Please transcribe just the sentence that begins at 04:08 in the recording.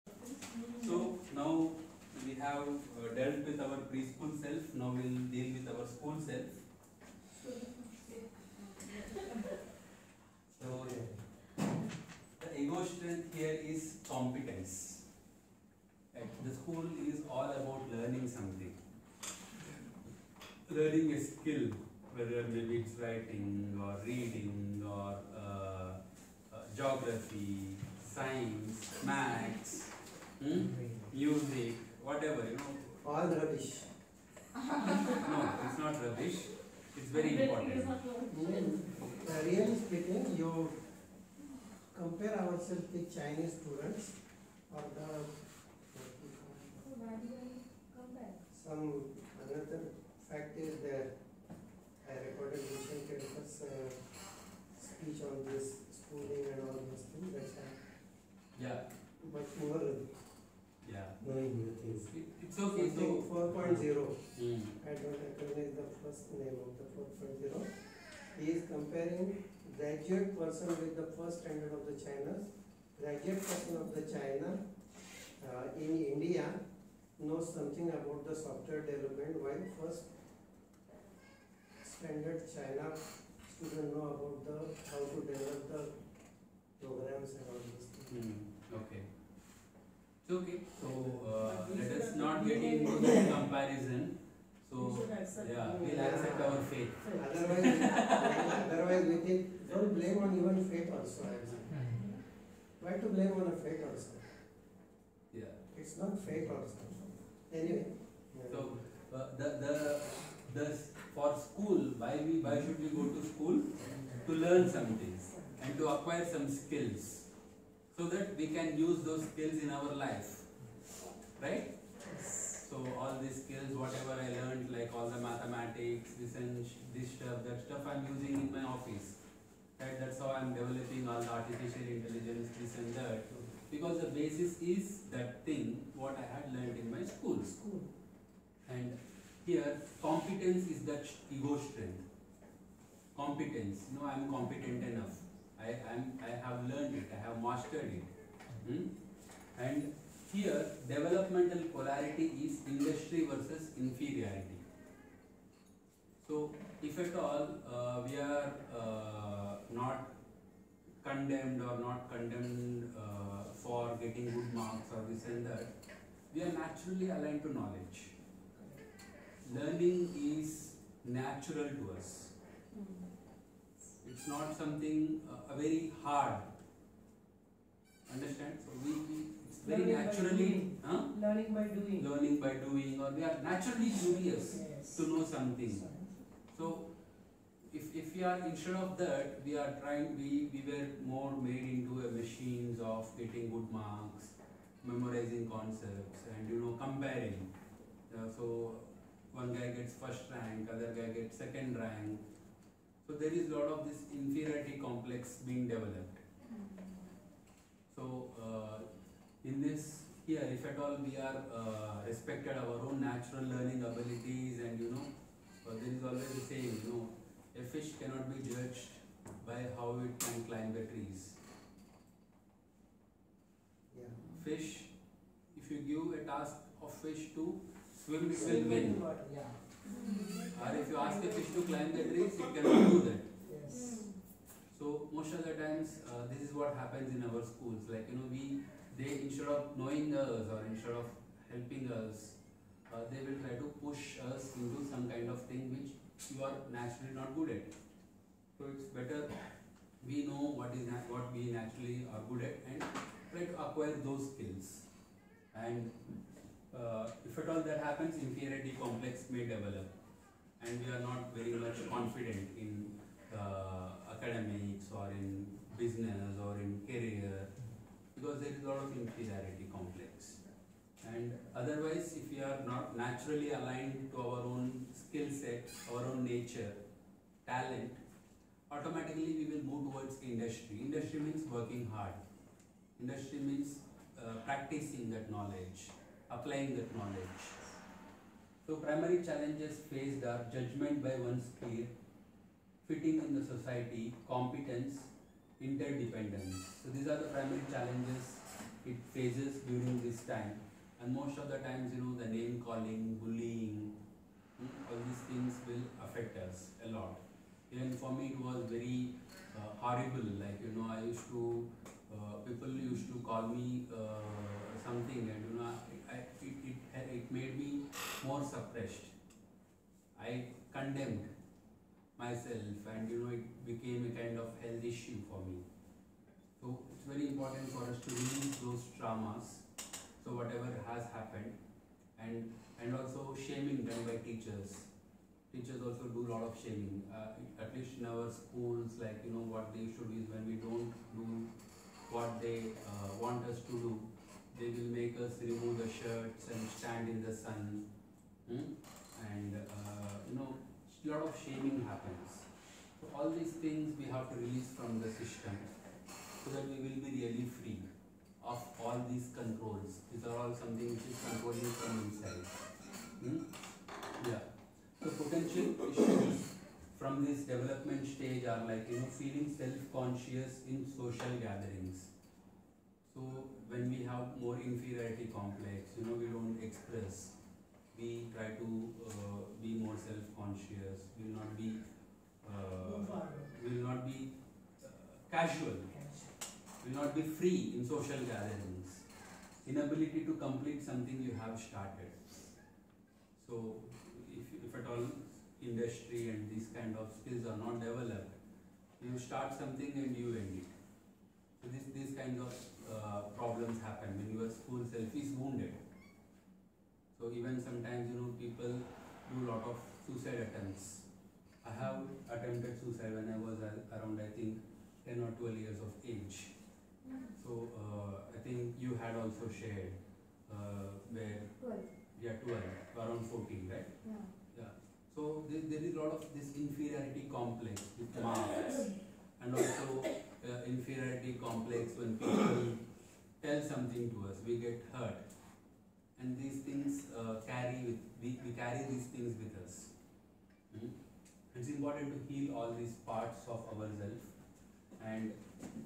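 So it's better we know what is what we naturally are good at and try to acquire those skills.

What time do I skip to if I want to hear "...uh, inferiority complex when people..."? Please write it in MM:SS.
07:10.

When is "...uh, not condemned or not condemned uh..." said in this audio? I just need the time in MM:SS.
02:38.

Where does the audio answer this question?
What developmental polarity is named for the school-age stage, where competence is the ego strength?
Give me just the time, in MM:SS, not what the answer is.
02:32.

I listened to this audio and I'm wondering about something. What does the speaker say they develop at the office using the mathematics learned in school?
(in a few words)
artificial intelligence.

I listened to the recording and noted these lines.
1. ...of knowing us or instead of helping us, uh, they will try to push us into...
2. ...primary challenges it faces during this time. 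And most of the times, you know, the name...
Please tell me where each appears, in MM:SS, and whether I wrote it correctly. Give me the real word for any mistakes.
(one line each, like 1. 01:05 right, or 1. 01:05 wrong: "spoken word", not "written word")
1. 03:59 right
2. 04:57 right.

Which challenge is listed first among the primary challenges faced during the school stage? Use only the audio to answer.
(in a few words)
judgment by one's peer.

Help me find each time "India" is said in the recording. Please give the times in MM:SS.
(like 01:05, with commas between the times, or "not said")
01:16.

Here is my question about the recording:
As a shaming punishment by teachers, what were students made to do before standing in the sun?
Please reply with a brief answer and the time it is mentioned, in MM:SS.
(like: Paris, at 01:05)
remove the shirts, at 05:45.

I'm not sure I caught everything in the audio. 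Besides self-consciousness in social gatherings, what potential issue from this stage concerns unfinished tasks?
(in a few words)
inability to complete something.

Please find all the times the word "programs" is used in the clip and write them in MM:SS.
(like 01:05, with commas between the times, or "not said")
01:26.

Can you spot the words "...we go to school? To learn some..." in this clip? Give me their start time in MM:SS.
01:52.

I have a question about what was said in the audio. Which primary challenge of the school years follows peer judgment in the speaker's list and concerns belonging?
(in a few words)
fitting in the society.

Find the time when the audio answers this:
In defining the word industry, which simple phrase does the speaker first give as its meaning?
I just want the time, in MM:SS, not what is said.
04:41.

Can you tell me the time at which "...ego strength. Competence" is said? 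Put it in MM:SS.
02:21.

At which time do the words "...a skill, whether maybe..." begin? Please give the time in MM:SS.
00:21.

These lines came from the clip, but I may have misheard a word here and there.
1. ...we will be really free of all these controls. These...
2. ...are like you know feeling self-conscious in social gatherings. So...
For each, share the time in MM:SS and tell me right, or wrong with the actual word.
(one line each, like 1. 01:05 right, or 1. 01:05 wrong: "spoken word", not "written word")
1. 05:56 right
2. 06:08 right.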